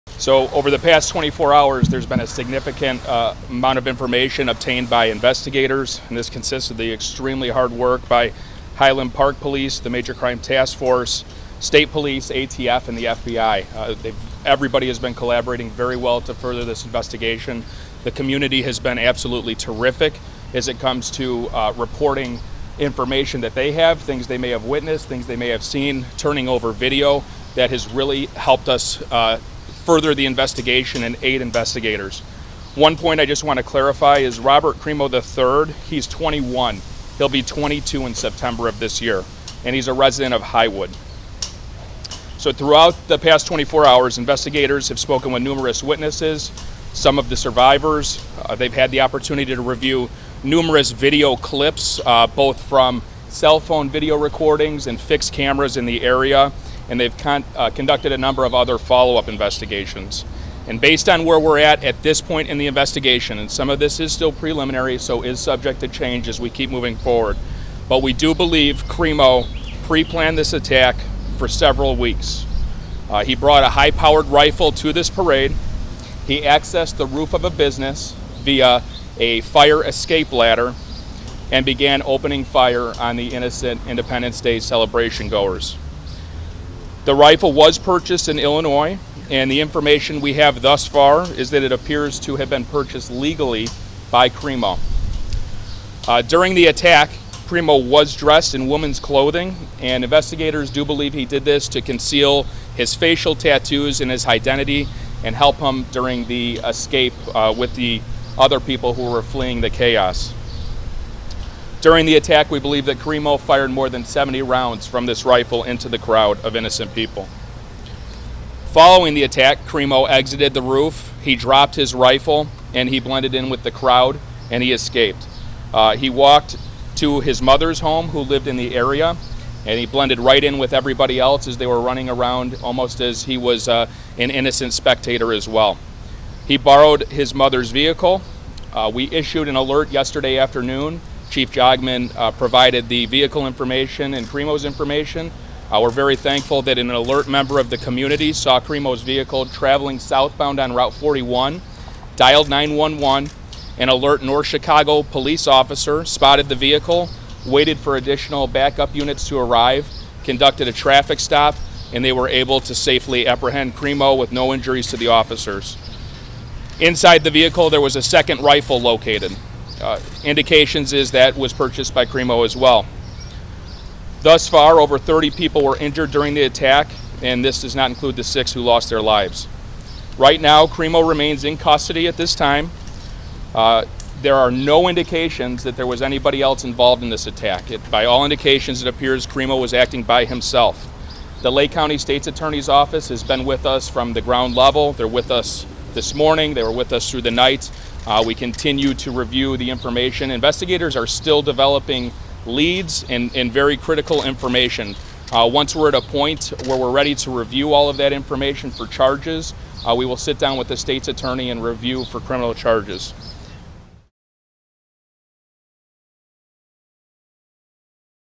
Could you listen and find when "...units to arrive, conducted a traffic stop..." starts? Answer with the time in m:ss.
2:38.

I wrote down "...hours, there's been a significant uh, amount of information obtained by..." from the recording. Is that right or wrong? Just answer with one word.
right.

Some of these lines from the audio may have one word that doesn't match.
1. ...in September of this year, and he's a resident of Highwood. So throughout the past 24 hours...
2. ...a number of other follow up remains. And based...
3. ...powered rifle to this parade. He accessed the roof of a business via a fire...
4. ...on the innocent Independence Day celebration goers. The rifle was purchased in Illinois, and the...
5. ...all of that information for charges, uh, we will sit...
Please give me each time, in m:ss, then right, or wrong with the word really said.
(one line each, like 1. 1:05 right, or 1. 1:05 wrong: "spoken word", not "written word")
1. 0:38 right
2. 0:58 wrong: "investigations", not "remains"
3. 1:13 right
4. 1:22 right
5. 3:27 right.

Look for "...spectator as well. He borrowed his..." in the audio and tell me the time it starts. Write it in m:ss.
2:14.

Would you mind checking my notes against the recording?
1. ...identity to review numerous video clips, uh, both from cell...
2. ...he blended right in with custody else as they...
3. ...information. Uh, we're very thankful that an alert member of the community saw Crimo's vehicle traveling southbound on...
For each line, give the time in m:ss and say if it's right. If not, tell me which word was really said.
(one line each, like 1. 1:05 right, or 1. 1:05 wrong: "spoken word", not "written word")
1. 0:49 wrong: "opportunity", not "identity"
2. 2:09 wrong: "everybody", not "custody"
3. 2:24 right.